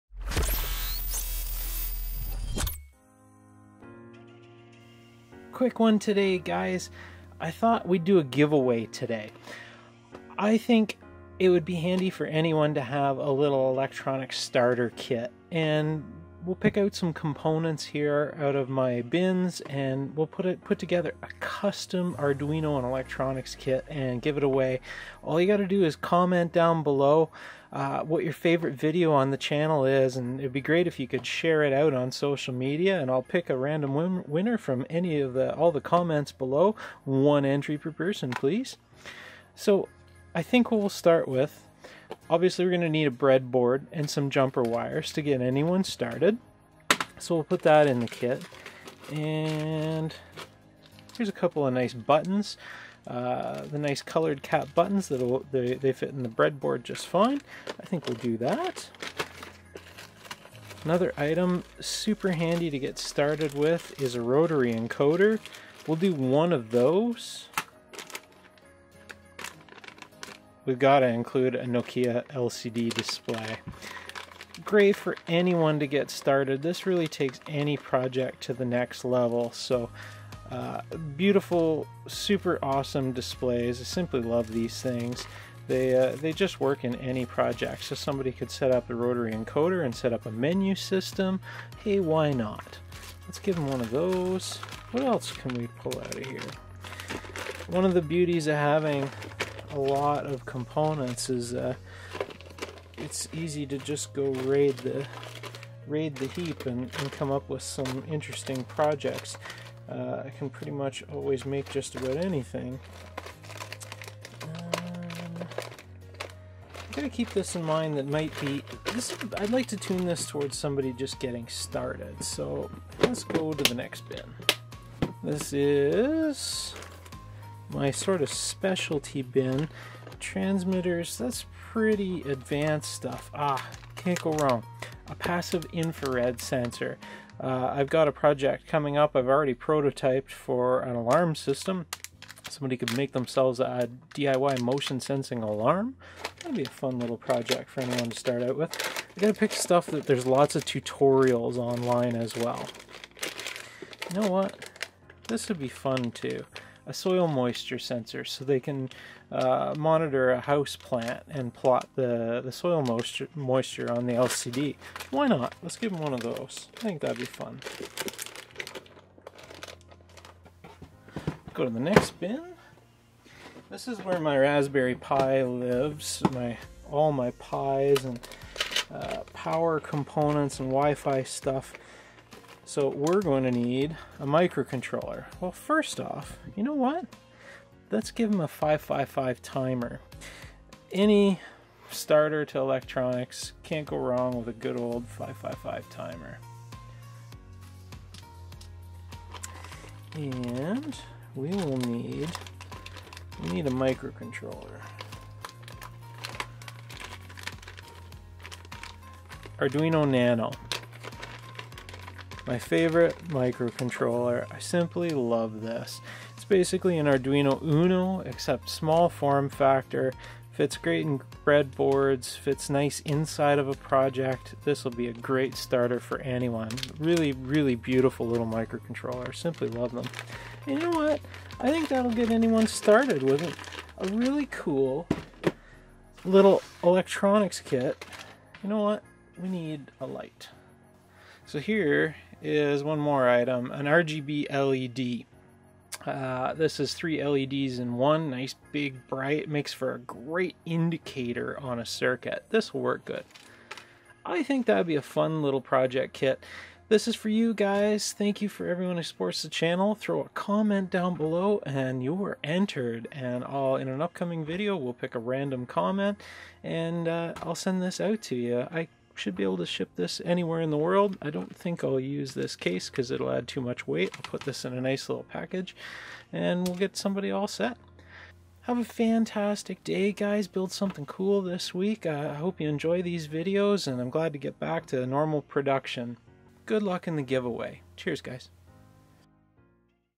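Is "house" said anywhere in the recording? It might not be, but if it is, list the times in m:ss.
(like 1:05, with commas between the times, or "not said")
2:40.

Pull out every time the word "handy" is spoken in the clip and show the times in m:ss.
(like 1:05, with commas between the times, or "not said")
0:11, 1:02.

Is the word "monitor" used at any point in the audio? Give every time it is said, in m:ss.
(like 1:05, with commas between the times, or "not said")
2:39.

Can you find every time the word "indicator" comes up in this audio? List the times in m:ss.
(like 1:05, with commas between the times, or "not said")
4:10.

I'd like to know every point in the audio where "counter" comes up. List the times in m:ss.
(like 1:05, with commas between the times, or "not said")
not said.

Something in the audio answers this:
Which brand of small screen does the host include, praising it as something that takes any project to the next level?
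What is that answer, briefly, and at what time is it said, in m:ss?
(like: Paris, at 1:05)
Nokia, at 1:11.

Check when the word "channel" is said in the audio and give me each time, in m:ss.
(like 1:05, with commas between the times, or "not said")
0:29, 4:19.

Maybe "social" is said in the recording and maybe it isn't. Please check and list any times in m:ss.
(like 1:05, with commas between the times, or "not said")
0:32.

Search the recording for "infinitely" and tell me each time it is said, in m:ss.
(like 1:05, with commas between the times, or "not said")
not said.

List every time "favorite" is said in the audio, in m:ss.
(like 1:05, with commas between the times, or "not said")
0:28, 3:32.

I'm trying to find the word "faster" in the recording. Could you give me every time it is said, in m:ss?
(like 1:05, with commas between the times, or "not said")
not said.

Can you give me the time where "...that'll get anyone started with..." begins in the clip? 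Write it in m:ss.
3:51.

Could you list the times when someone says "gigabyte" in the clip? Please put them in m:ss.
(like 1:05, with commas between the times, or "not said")
not said.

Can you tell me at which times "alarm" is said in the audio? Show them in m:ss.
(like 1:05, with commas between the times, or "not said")
2:20, 2:25.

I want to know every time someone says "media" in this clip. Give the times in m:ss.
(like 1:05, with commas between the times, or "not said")
0:32.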